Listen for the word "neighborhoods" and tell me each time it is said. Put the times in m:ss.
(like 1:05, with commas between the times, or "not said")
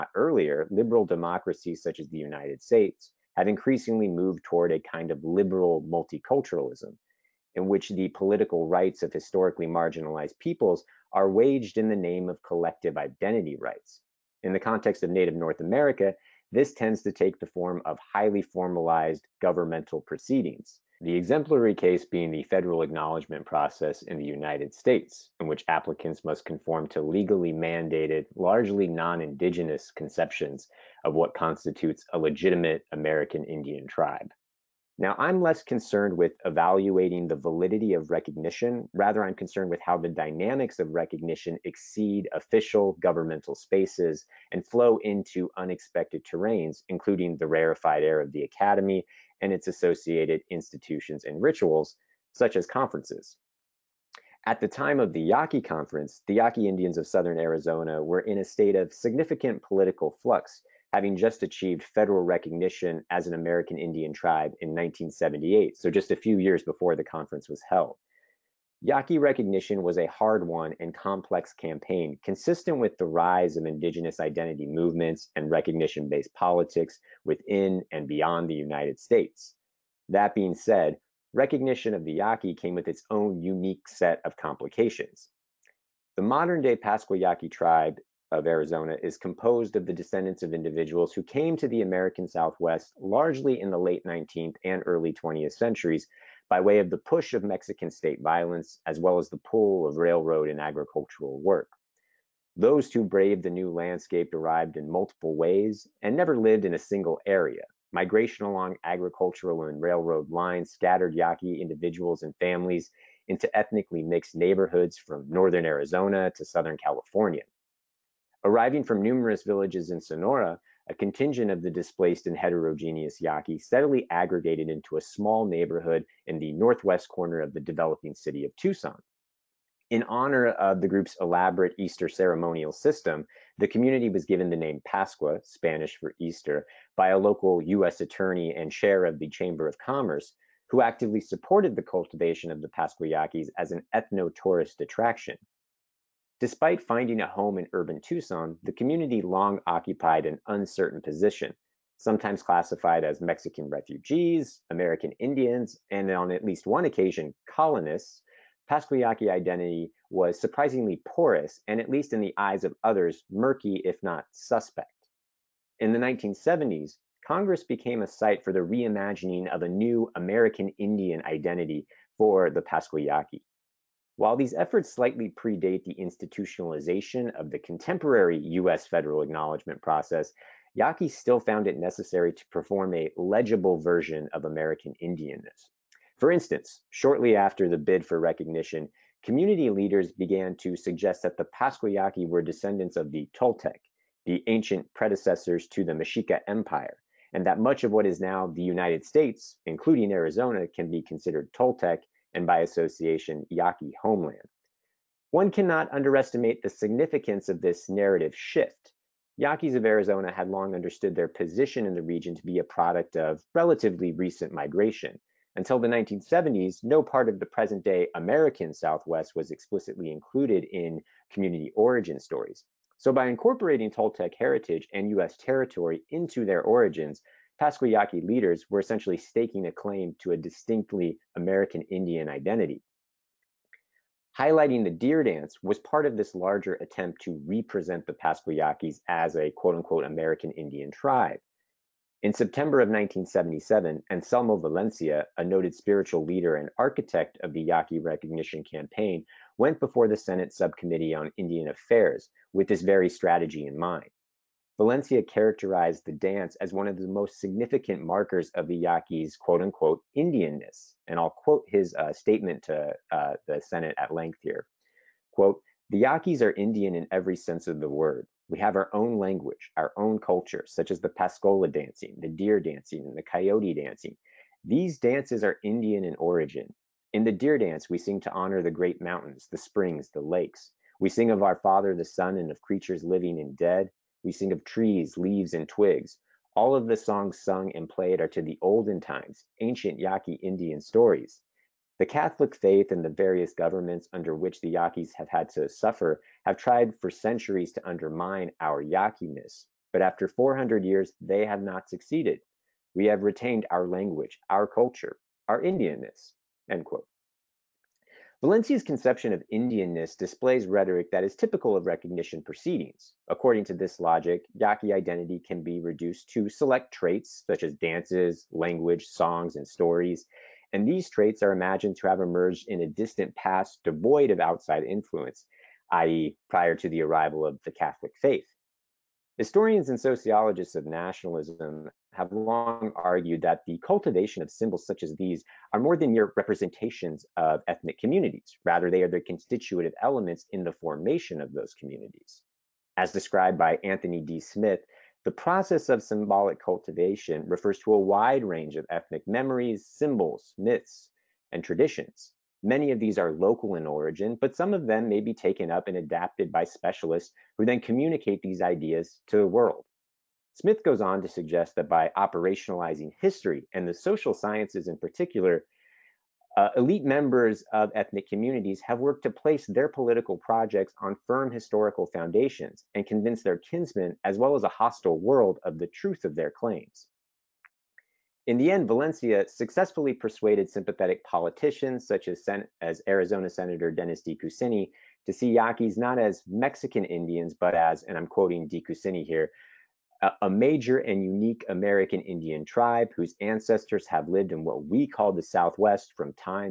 1:54, 2:05.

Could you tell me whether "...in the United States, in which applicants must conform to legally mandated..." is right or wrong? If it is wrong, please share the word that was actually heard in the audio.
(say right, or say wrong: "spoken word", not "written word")
right.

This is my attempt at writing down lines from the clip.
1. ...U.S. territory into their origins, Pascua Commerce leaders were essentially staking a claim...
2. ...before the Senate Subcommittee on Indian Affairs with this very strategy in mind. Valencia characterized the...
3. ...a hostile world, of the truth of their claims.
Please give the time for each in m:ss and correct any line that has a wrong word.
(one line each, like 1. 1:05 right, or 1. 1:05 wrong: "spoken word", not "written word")
1. 3:45 wrong: "Yaqui", not "Commerce"
2. 4:09 right
3. 6:14 right.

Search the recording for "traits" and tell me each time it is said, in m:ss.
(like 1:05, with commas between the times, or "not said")
5:16, 5:21.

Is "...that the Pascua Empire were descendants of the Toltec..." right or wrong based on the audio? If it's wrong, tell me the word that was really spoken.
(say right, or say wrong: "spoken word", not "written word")
wrong: "Yaqui", not "Empire".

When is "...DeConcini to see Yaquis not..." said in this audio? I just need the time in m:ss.
6:24.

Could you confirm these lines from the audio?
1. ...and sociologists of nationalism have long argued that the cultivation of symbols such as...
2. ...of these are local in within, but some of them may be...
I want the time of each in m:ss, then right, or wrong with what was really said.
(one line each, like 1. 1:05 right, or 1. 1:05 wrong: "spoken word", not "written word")
1. 5:29 right
2. 5:52 wrong: "origin", not "within".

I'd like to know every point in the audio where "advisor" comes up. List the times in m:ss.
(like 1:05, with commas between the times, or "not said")
not said.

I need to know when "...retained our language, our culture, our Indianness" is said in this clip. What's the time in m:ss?
5:03.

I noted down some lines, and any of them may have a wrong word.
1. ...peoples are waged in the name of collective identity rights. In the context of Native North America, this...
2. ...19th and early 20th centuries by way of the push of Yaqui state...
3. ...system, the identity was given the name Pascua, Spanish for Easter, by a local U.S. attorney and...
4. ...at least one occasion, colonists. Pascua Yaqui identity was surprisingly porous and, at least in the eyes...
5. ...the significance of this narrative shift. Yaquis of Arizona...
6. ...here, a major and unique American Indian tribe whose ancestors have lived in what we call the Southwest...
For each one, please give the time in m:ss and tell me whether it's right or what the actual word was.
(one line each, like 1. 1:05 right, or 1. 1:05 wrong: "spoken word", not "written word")
1. 0:10 right
2. 1:34 wrong: "Mexican", not "Yaqui"
3. 2:12 wrong: "community", not "identity"
4. 2:36 right
5. 3:26 right
6. 6:29 right.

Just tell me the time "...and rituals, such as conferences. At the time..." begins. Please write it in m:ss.
0:51.